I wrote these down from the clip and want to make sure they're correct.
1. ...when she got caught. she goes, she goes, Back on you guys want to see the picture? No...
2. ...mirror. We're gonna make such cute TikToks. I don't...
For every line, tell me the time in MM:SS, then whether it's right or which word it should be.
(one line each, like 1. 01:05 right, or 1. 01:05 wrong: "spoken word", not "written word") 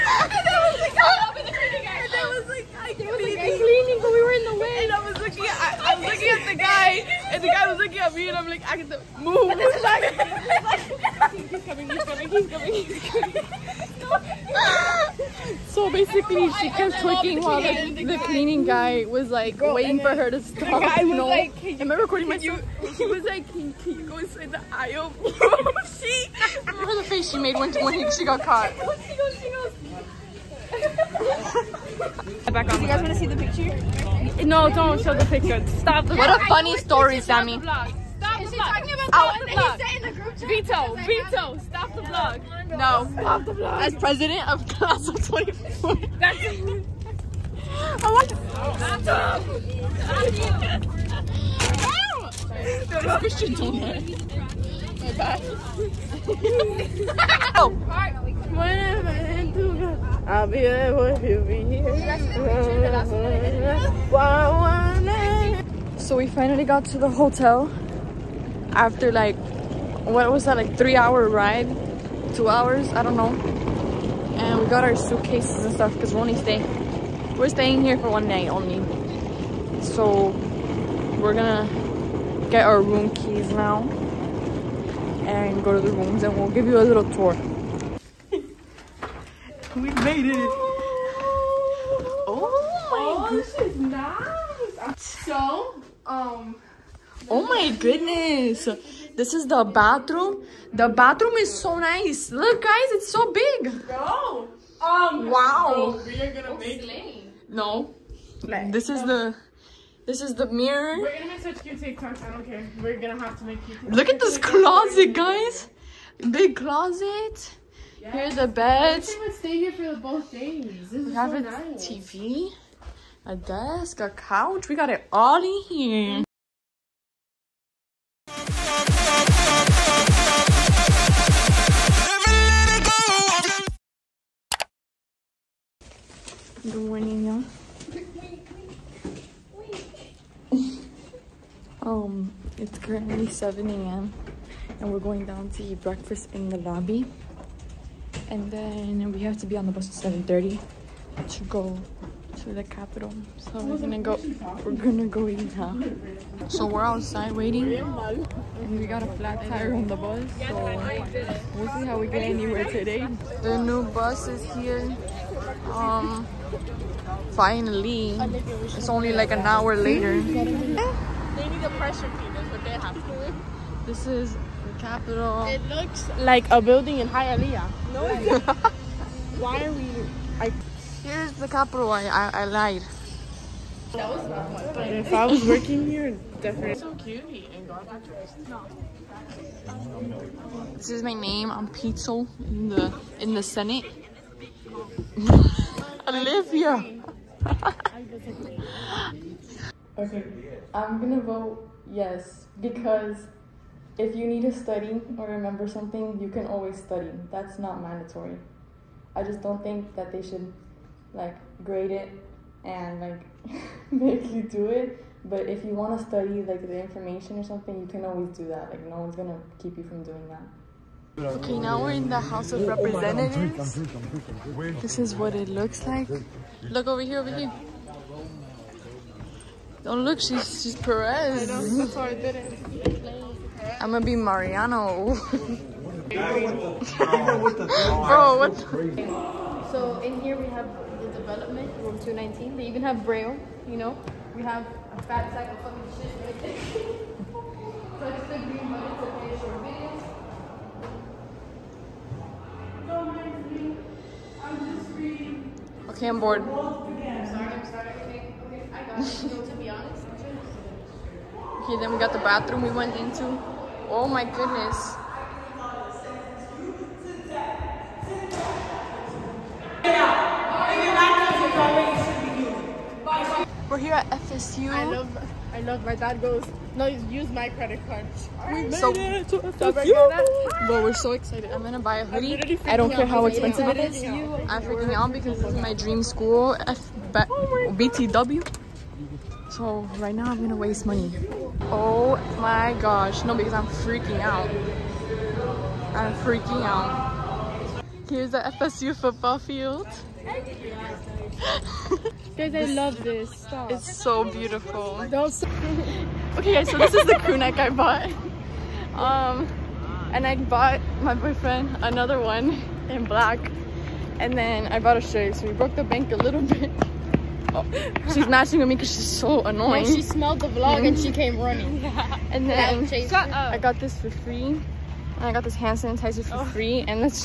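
1. 00:27 right
2. 01:50 right.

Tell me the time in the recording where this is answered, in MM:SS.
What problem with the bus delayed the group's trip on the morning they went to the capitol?
02:39.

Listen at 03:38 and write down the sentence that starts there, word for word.
Like no one's gonna keep you from doing that.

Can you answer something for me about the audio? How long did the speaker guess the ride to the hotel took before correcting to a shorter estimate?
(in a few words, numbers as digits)
3 hours.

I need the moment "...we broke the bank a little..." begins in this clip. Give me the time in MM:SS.
05:15.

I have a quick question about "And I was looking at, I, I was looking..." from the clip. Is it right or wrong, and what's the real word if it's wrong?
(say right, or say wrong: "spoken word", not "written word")
right.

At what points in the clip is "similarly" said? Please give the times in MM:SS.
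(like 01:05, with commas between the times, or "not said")
not said.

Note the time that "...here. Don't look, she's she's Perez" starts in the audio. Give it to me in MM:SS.
03:47.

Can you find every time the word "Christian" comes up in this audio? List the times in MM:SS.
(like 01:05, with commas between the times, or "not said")
00:53.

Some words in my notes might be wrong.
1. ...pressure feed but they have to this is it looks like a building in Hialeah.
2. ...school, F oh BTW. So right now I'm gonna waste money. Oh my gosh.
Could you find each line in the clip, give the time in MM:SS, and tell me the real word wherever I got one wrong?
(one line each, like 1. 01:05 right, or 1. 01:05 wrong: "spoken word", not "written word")
1. 02:51 right
2. 04:46 right.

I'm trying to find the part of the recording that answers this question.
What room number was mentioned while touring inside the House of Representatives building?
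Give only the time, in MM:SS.
04:02.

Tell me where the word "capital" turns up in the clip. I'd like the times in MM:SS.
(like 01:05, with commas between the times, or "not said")
02:32, 03:01.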